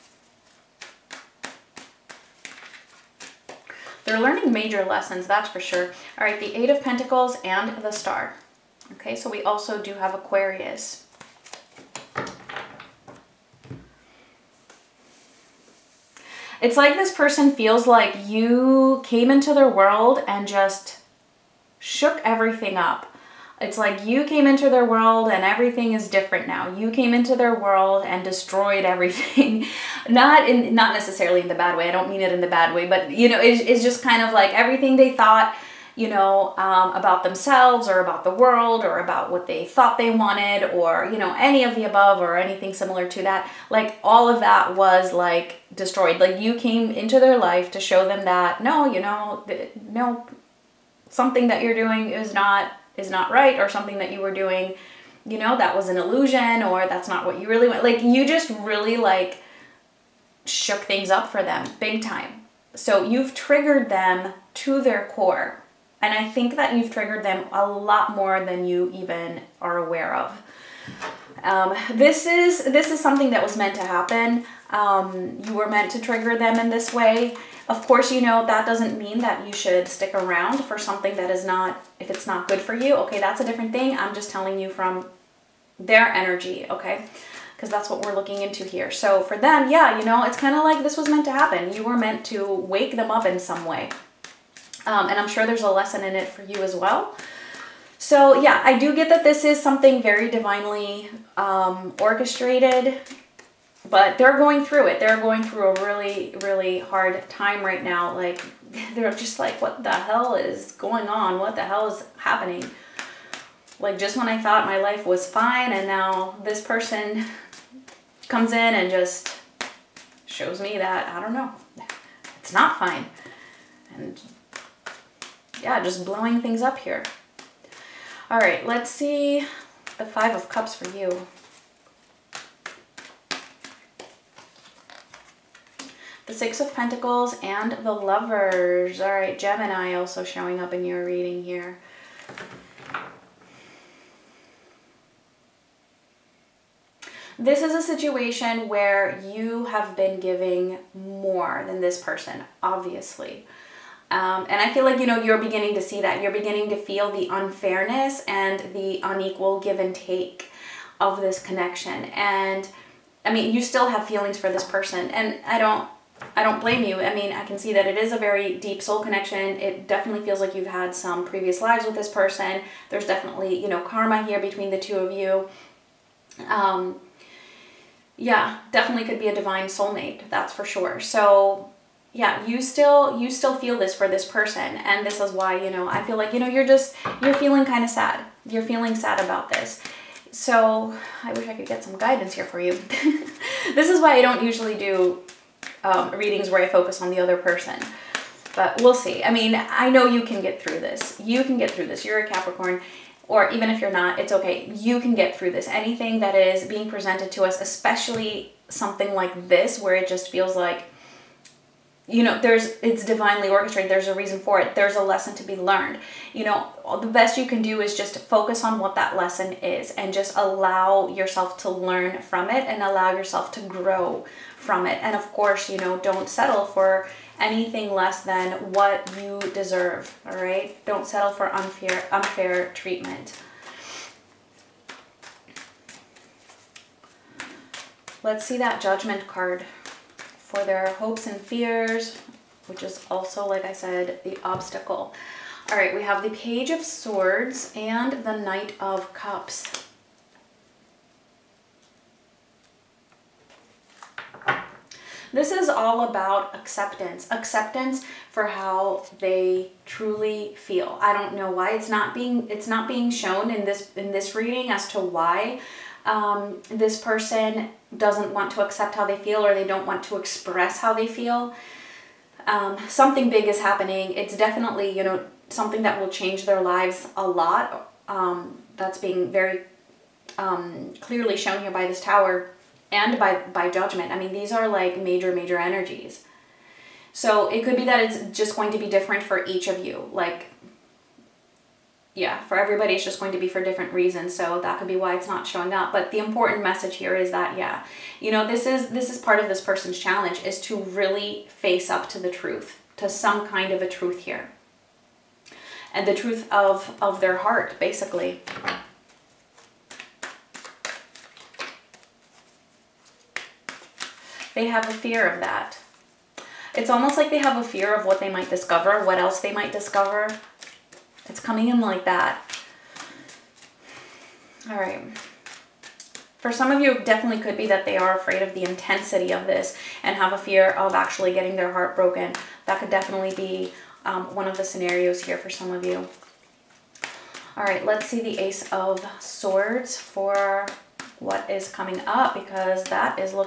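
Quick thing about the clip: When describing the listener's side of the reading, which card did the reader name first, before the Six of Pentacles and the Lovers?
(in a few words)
Five of Cups.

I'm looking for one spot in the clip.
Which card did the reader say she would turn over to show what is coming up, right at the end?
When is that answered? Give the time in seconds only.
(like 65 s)
338 s.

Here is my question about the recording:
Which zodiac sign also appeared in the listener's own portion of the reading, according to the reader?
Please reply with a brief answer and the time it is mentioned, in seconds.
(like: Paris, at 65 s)
Gemini, at 139 s.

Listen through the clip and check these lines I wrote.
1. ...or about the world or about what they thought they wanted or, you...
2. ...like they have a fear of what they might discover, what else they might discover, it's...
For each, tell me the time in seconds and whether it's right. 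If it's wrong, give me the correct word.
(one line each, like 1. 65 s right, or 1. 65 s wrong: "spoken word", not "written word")
1. 37 s right
2. 317 s right.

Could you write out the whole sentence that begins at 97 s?
So, yeah, I do get that this is something very divinely um, orchestrated, but they're going through it.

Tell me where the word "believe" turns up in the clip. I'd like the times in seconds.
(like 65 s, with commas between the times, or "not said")
not said.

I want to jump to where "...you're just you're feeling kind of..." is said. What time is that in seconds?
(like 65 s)
186 s.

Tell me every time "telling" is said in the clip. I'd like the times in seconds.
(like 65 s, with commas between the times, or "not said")
84 s.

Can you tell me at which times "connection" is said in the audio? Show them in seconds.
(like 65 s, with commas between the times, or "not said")
161 s, 169 s.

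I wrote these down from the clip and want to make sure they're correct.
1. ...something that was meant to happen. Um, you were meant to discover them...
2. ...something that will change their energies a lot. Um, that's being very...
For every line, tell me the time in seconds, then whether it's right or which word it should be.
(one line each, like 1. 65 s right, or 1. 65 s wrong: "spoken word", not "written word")
1. 72 s wrong: "trigger", not "discover"
2. 275 s wrong: "lives", not "energies".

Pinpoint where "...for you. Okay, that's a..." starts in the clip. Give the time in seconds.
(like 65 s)
82 s.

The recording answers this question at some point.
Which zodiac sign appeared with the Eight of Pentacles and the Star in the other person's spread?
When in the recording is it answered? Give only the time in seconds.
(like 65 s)
10 s.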